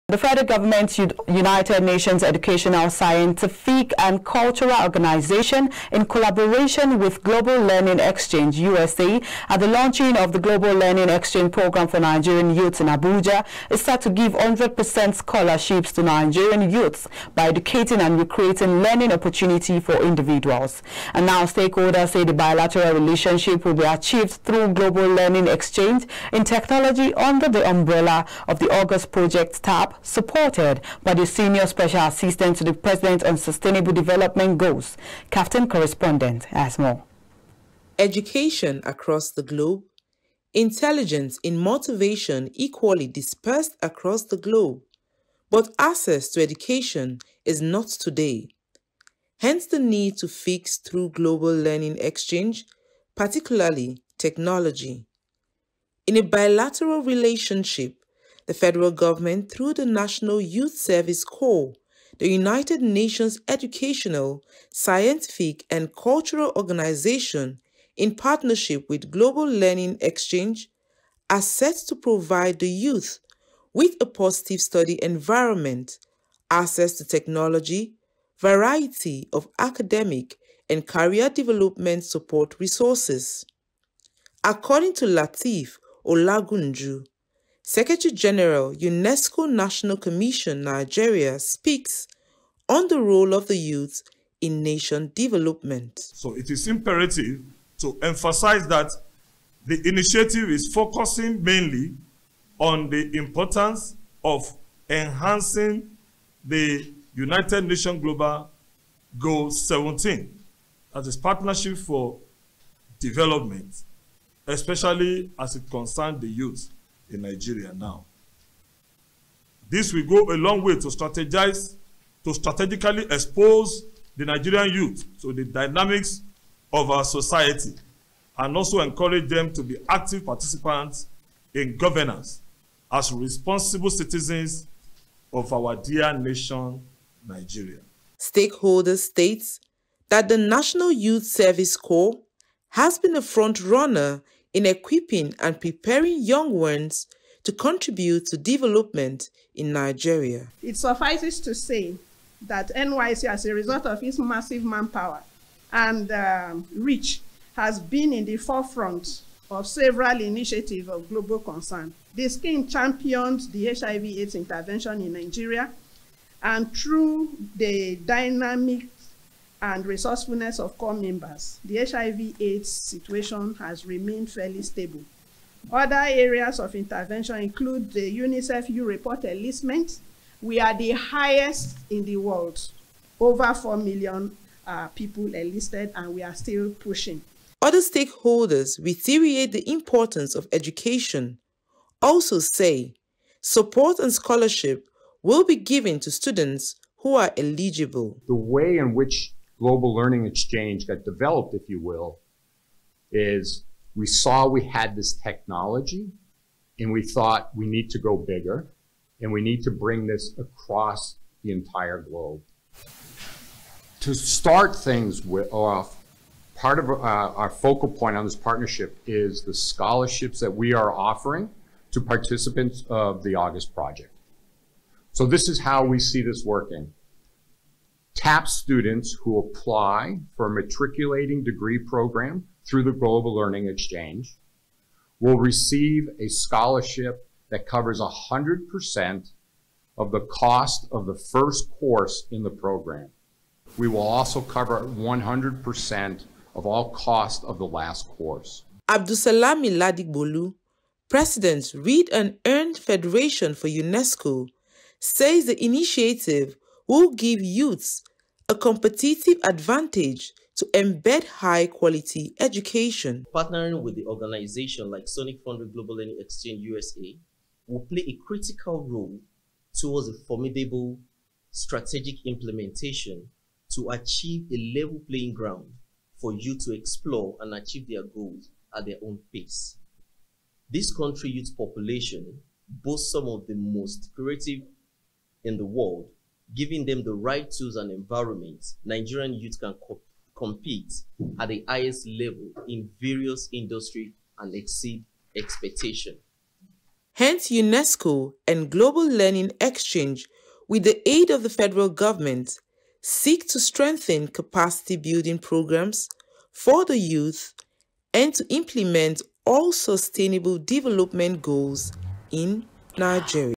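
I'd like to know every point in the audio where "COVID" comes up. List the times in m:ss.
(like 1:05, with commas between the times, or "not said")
not said.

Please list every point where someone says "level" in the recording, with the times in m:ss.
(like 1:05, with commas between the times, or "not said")
4:34, 4:52.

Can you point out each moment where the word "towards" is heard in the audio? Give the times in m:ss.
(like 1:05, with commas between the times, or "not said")
4:29.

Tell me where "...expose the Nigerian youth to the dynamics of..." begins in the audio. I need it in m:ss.
2:03.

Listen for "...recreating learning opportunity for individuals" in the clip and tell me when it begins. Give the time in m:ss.
0:18.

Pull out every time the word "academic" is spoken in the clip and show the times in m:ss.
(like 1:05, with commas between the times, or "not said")
1:19.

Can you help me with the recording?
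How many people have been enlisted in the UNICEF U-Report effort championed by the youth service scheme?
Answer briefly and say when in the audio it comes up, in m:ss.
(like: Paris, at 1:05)
over 4 million, at 3:03.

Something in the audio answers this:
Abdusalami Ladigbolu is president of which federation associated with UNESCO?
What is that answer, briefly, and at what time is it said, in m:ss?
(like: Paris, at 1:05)
Read and Earn Federation, at 4:11.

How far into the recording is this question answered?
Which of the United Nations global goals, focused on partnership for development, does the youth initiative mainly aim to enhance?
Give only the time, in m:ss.
1:48.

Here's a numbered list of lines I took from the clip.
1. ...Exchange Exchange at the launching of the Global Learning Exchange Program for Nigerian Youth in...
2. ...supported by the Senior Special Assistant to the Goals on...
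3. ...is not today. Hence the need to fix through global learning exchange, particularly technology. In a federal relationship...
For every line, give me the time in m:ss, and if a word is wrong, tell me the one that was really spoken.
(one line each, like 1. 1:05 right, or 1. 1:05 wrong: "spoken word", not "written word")
1. 0:07 wrong: "USA", not "Exchange"
2. 0:30 wrong: "President", not "Goals"
3. 0:47 wrong: "bilateral", not "federal".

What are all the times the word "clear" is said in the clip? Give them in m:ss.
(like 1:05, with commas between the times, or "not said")
not said.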